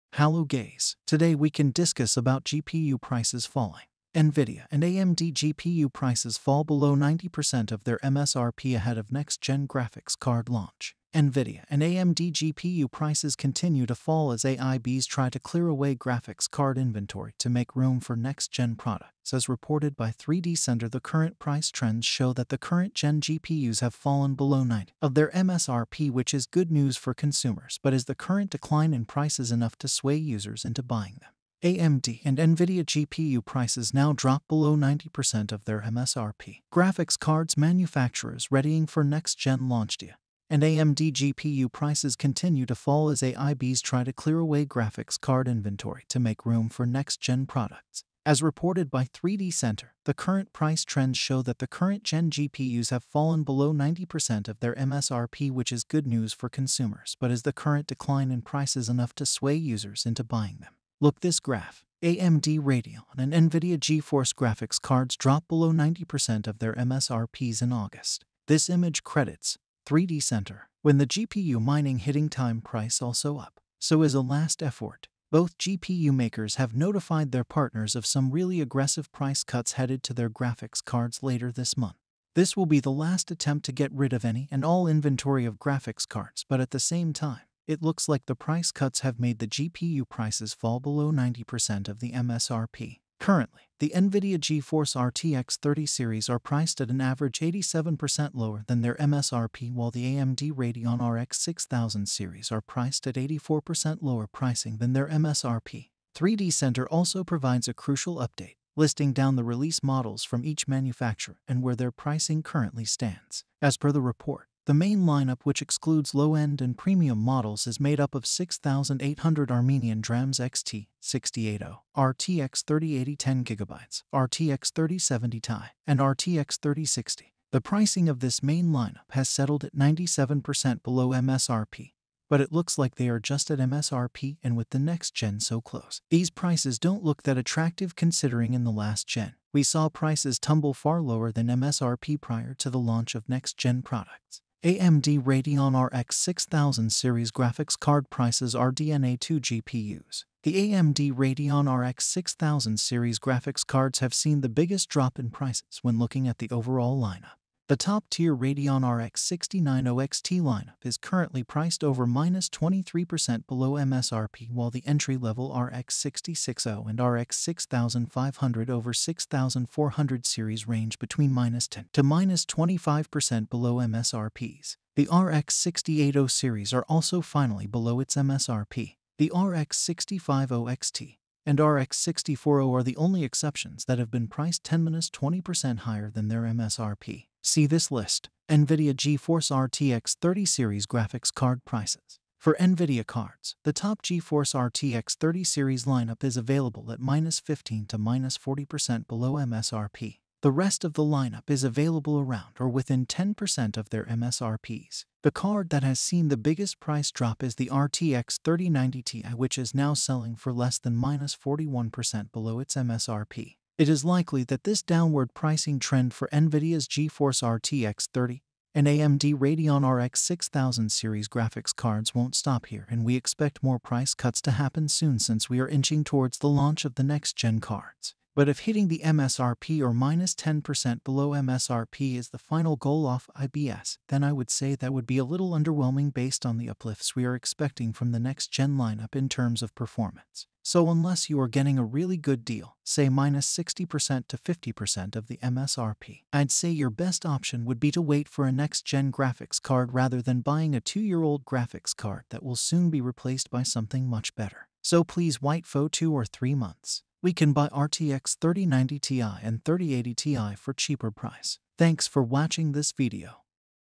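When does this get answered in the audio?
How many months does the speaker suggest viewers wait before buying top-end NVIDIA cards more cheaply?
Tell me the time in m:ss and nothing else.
4:15.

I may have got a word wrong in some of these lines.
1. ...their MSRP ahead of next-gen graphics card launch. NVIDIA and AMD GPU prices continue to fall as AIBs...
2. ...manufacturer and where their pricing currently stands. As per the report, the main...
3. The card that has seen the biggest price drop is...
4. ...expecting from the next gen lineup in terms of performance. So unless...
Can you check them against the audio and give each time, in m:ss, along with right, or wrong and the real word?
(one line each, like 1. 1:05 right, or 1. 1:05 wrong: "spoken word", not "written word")
1. 0:07 right
2. 1:50 right
3. 3:25 right
4. 3:57 right.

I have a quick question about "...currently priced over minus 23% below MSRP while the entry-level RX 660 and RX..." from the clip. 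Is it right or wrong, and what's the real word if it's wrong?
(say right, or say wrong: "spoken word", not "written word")
right.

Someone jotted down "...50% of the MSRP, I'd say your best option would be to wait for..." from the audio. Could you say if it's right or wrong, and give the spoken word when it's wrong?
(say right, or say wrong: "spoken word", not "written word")
right.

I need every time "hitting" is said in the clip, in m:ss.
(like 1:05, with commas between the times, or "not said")
1:11, 3:48.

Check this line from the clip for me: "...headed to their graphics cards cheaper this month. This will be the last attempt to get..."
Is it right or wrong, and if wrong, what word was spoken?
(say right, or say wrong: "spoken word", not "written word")
wrong: "later", not "cheaper".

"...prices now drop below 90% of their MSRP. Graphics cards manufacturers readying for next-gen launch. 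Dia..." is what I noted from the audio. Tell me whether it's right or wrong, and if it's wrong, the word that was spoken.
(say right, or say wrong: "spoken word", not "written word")
right.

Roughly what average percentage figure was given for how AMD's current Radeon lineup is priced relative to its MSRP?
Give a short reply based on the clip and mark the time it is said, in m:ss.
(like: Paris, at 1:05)
84%, at 1:43.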